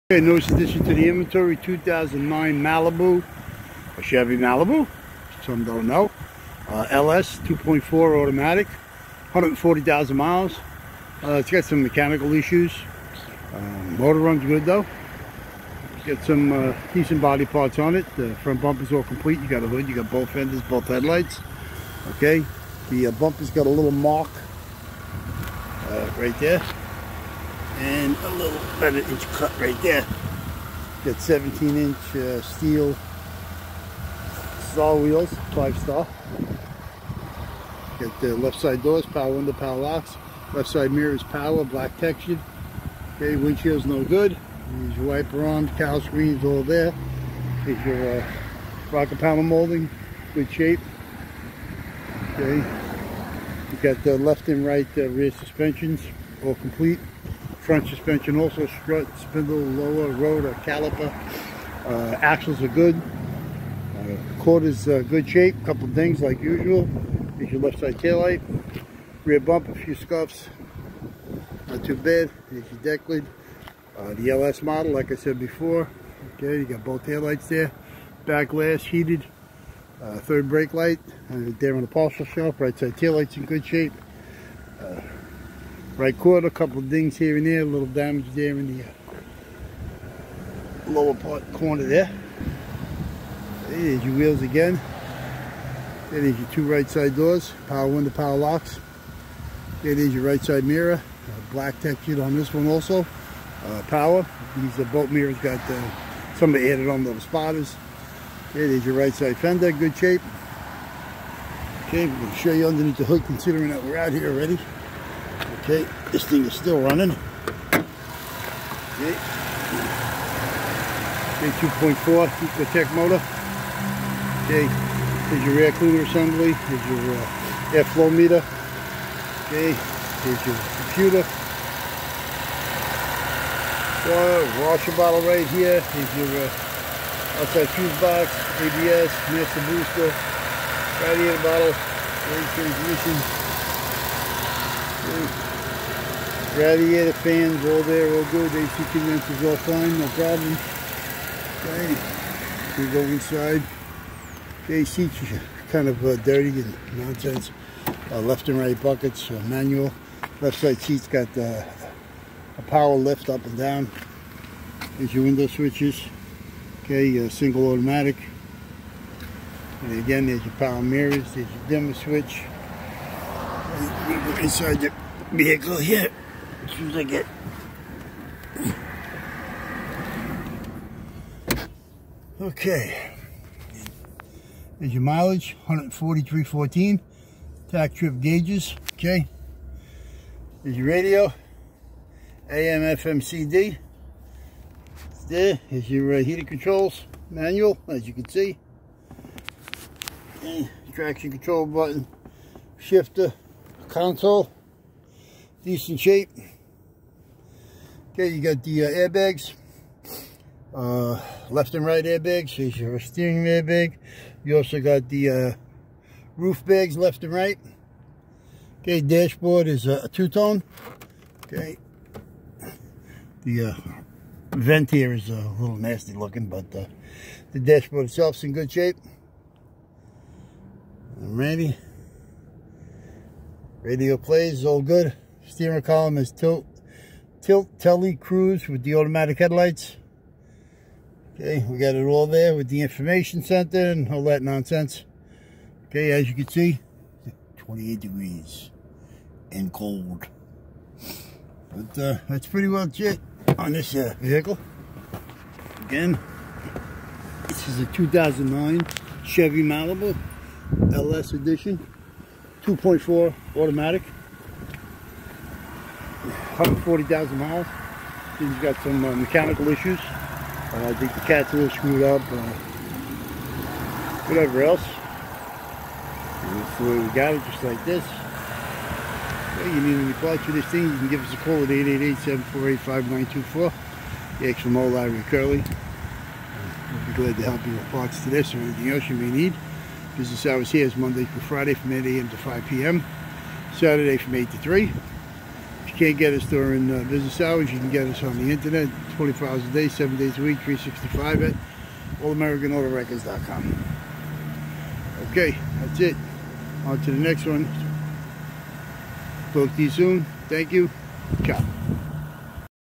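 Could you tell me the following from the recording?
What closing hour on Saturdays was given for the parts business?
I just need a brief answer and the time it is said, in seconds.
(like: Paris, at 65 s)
3, at 294 s.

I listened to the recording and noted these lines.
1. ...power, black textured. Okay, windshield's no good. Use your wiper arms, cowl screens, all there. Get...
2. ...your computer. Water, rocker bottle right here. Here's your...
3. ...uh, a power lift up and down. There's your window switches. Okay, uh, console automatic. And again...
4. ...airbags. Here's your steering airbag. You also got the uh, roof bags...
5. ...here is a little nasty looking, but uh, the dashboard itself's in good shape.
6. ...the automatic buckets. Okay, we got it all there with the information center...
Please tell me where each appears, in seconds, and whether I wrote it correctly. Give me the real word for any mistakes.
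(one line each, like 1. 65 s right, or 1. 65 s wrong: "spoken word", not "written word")
1. 41 s right
2. 130 s wrong: "washer", not "rocker"
3. 161 s wrong: "single", not "console"
4. 212 s right
5. 224 s right
6. 238 s wrong: "headlights", not "buckets".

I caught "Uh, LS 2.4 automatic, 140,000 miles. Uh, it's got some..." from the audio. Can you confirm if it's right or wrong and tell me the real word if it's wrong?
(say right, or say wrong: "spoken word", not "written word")
right.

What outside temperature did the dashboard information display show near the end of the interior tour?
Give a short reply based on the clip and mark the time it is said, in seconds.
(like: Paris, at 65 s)
28 degrees, at 247 s.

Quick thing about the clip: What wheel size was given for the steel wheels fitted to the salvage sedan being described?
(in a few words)
17 inch.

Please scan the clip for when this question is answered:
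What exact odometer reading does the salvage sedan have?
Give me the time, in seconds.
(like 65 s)
185 s.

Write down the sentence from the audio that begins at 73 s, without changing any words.
Uh, the LS model, like I said before.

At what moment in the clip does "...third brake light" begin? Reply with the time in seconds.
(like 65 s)
80 s.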